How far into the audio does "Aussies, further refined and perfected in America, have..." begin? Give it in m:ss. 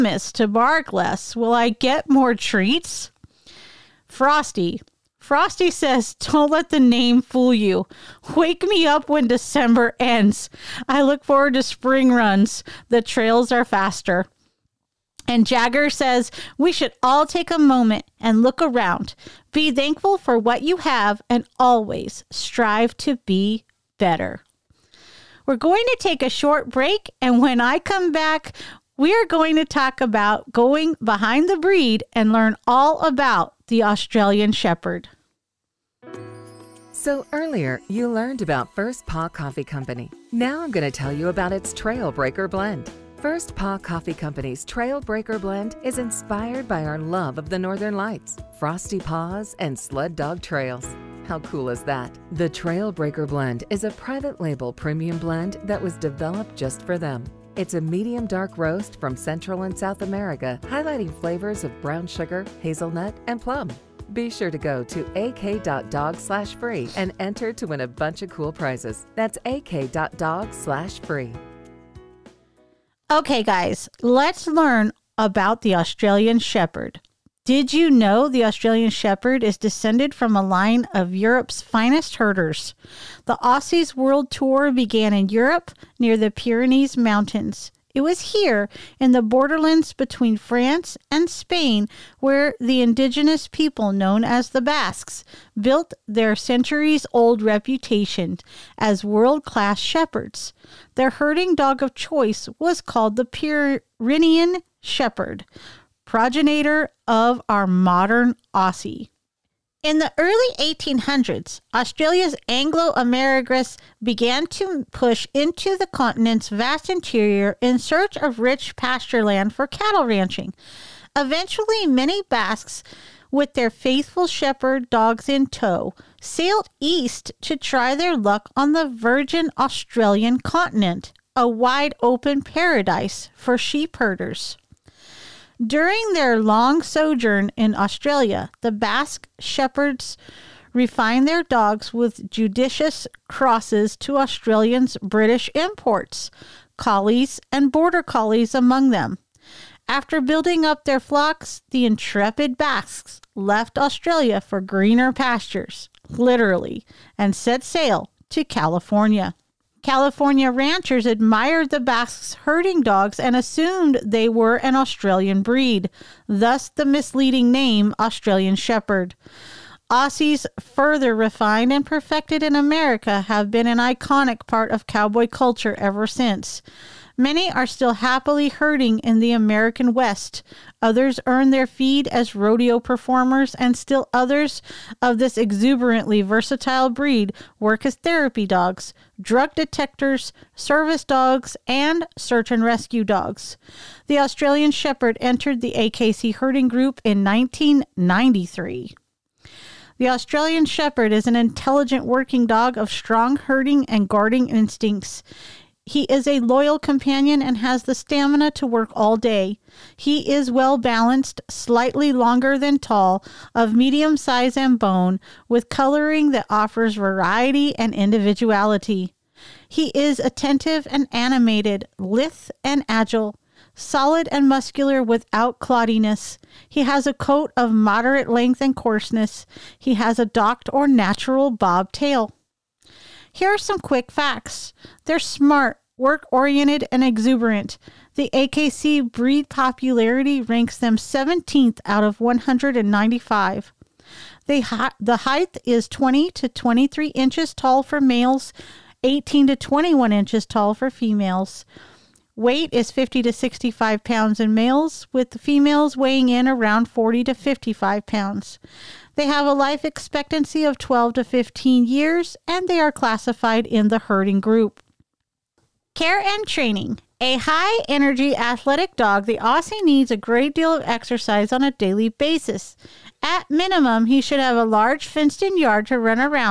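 2:49.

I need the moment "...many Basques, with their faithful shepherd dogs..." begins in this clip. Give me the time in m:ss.
2:01.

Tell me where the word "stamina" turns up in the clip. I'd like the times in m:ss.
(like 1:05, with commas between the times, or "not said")
3:27.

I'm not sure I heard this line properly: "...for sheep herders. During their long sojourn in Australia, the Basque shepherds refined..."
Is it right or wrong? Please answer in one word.
right.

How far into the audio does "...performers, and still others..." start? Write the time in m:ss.
3:02.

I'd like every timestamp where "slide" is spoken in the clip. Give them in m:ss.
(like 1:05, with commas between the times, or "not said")
not said.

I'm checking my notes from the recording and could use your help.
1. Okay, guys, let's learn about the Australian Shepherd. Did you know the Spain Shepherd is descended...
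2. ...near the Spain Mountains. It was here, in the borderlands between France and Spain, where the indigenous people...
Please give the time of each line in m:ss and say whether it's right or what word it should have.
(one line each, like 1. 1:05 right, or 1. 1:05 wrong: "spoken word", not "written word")
1. 1:13 wrong: "Australian", not "Spain"
2. 1:25 wrong: "Pyrenees", not "Spain".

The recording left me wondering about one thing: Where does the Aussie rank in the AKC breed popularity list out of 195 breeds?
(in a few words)
17th.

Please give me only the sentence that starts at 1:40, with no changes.
Their herding dog of choice was called the Pyrenean Shepherd, progenitor of our modern Aussie.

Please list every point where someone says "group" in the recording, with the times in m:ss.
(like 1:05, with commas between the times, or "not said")
3:16, 4:24.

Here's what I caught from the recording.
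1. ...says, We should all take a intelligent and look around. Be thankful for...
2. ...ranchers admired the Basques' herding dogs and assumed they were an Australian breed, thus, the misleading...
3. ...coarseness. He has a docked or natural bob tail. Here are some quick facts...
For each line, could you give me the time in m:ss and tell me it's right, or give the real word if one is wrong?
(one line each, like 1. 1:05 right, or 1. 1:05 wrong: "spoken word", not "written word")
1. 0:15 wrong: "moment", not "intelligent"
2. 2:40 right
3. 3:48 right.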